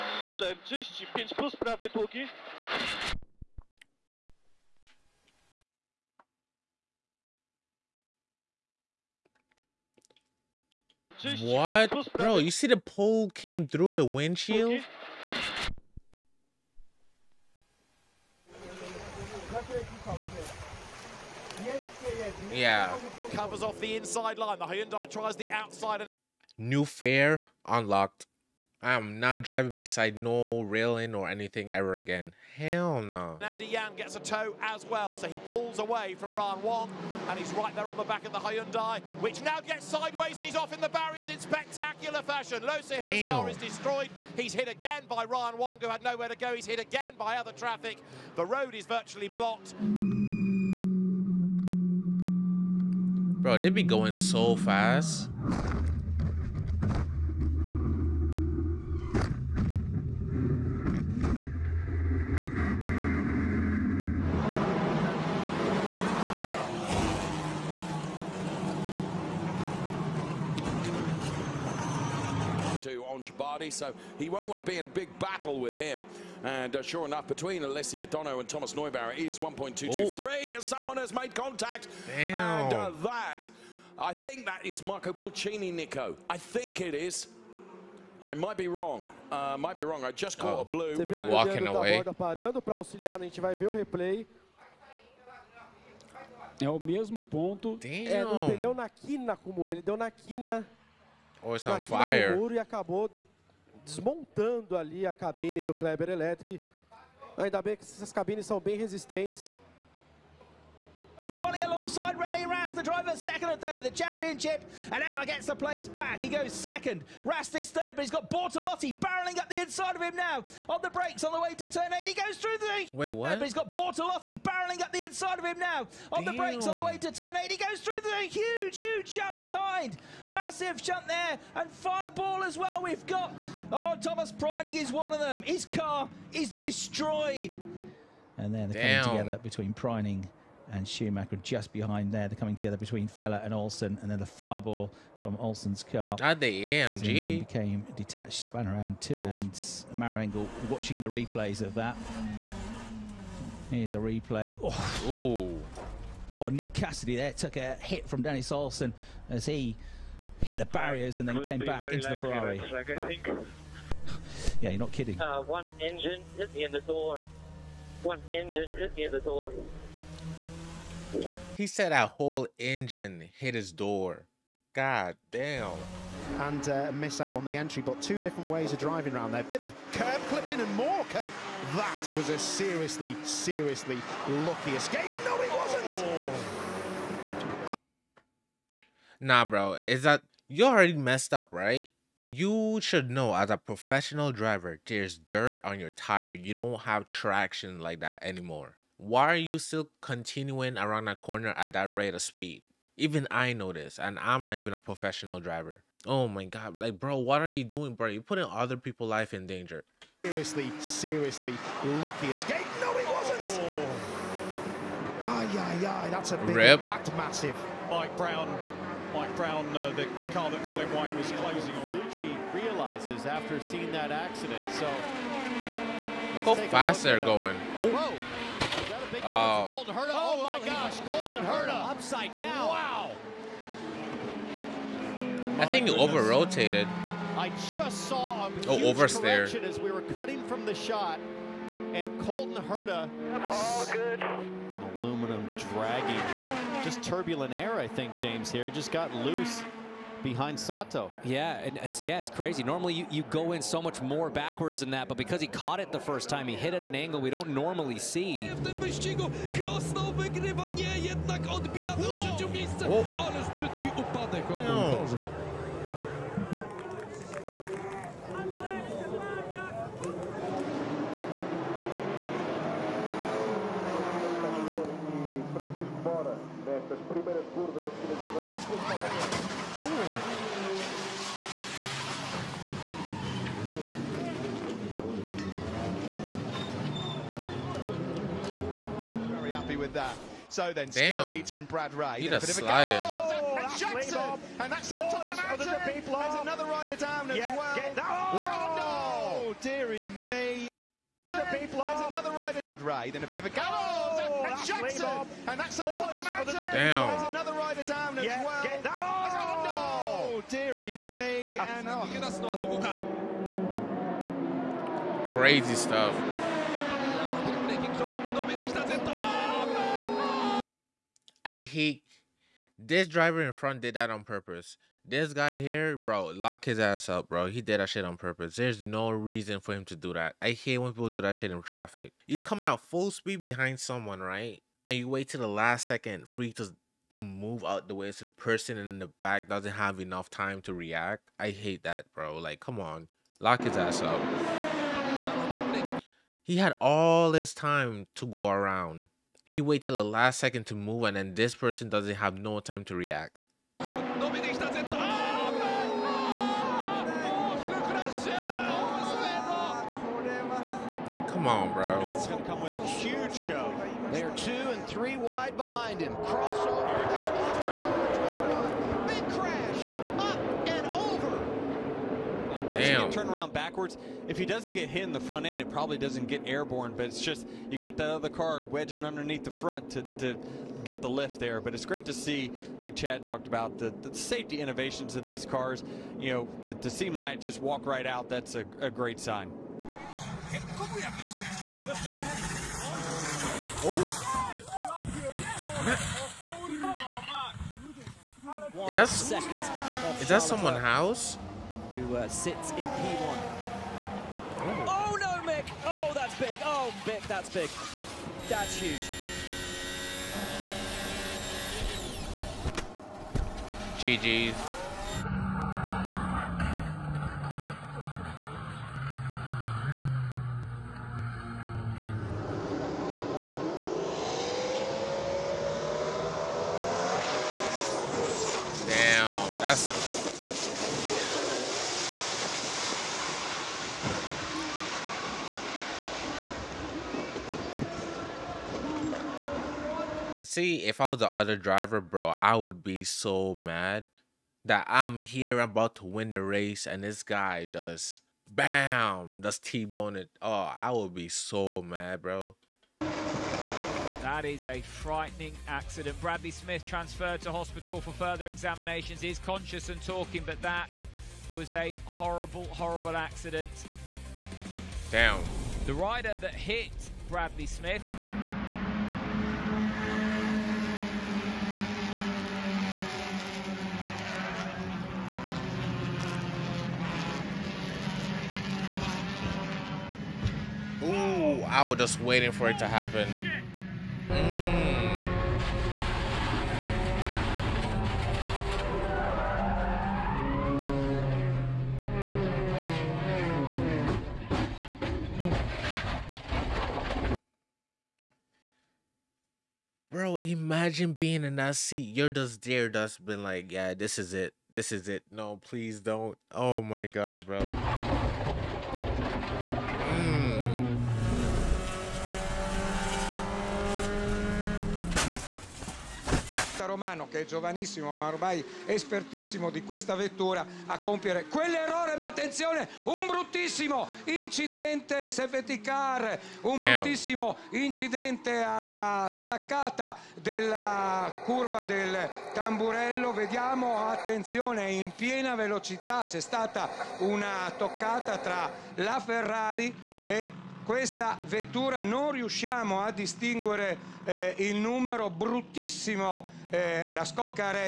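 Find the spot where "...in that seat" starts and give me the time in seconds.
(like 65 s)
501 s.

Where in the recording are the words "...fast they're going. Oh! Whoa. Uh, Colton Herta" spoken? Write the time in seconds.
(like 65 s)
226 s.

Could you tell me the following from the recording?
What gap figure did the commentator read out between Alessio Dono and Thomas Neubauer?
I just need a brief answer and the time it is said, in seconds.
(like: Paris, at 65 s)
1.223, at 79 s.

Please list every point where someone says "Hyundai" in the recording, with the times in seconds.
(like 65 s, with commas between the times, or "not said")
24 s, 38 s.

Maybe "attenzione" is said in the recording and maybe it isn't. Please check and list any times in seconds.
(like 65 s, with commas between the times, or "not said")
522 s, 534 s.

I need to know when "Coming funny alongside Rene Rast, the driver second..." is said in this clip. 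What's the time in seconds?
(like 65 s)
111 s.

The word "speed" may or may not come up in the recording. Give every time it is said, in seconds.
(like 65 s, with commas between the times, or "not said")
202 s, 333 s.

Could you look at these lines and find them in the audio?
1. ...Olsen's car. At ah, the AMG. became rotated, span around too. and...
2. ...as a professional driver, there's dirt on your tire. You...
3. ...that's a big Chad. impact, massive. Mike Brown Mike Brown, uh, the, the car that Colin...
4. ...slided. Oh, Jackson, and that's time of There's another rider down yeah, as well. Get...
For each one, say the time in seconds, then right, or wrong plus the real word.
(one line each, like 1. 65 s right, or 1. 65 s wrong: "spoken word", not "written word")
1. 145 s wrong: "detached", not "rotated"
2. 193 s right
3. 216 s wrong: "Rip", not "Chad"
4. 292 s right.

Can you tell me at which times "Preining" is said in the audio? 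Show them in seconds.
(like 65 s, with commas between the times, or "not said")
134 s, 139 s.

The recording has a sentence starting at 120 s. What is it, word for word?
On the brakes on the way to turn eight.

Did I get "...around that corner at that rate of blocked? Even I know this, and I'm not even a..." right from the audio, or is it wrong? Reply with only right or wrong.
wrong.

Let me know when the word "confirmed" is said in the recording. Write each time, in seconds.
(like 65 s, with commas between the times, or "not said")
not said.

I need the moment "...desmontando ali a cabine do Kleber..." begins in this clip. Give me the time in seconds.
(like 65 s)
103 s.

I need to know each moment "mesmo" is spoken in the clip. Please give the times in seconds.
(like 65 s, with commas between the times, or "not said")
96 s.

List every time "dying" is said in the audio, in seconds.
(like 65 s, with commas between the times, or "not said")
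not said.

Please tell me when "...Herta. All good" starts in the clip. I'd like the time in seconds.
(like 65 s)
242 s.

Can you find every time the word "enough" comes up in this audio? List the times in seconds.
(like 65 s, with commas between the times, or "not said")
77 s, 339 s.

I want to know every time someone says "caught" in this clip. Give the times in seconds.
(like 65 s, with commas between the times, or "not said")
90 s, 255 s.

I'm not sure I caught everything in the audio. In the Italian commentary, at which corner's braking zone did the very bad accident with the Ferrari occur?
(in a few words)
Tamburello.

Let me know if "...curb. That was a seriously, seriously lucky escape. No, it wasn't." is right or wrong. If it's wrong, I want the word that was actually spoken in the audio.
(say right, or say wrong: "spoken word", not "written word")
right.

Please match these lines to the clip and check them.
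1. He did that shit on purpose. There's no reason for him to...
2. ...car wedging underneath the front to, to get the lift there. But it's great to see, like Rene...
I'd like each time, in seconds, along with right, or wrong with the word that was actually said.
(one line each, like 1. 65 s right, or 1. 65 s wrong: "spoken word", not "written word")
1. 327 s right
2. 378 s wrong: "Chad", not "Rene".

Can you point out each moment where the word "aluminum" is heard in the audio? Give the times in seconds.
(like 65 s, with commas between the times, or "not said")
244 s.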